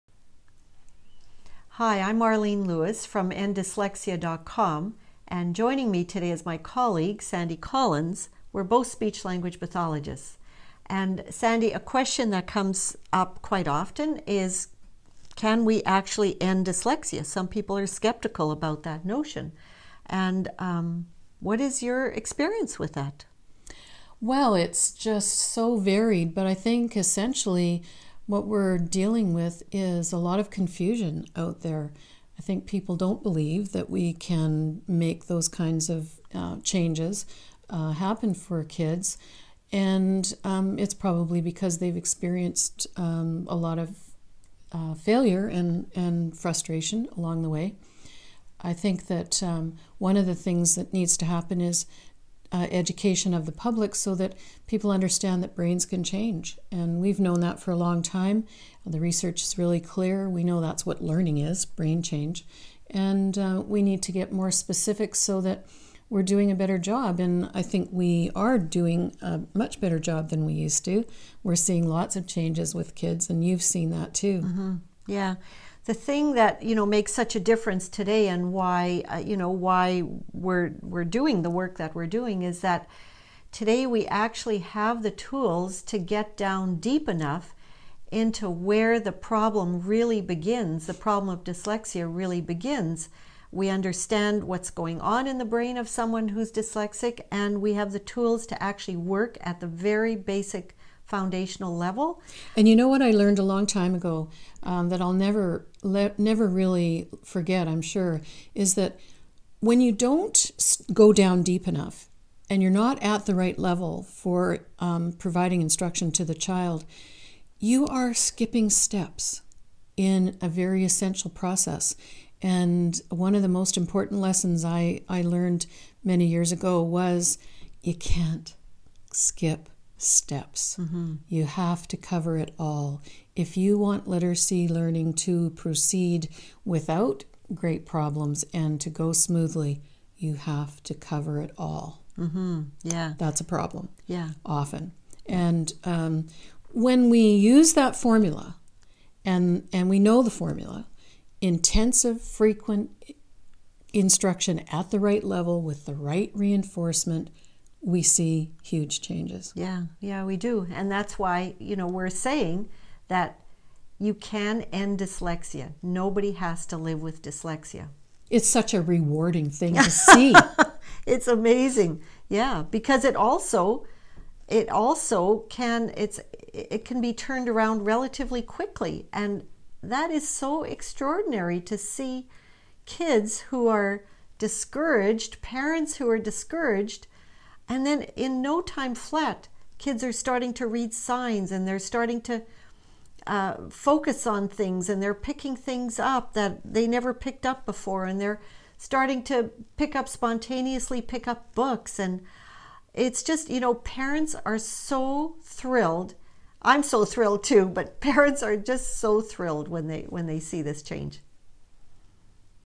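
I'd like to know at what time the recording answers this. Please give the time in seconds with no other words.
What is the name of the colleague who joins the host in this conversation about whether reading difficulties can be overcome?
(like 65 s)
7 s.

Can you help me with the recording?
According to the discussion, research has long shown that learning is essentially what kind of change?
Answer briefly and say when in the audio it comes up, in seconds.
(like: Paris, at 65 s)
Brain change, at 61 s.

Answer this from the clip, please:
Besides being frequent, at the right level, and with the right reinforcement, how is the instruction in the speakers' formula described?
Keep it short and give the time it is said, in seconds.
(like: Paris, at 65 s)
Intensive, at 151 s.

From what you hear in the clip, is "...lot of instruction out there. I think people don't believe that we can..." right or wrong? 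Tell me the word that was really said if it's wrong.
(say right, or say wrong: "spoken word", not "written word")
wrong: "confusion", not "instruction".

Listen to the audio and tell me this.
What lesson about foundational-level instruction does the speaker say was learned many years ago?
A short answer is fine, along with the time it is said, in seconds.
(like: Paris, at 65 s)
You can't skip steps, at 127 s.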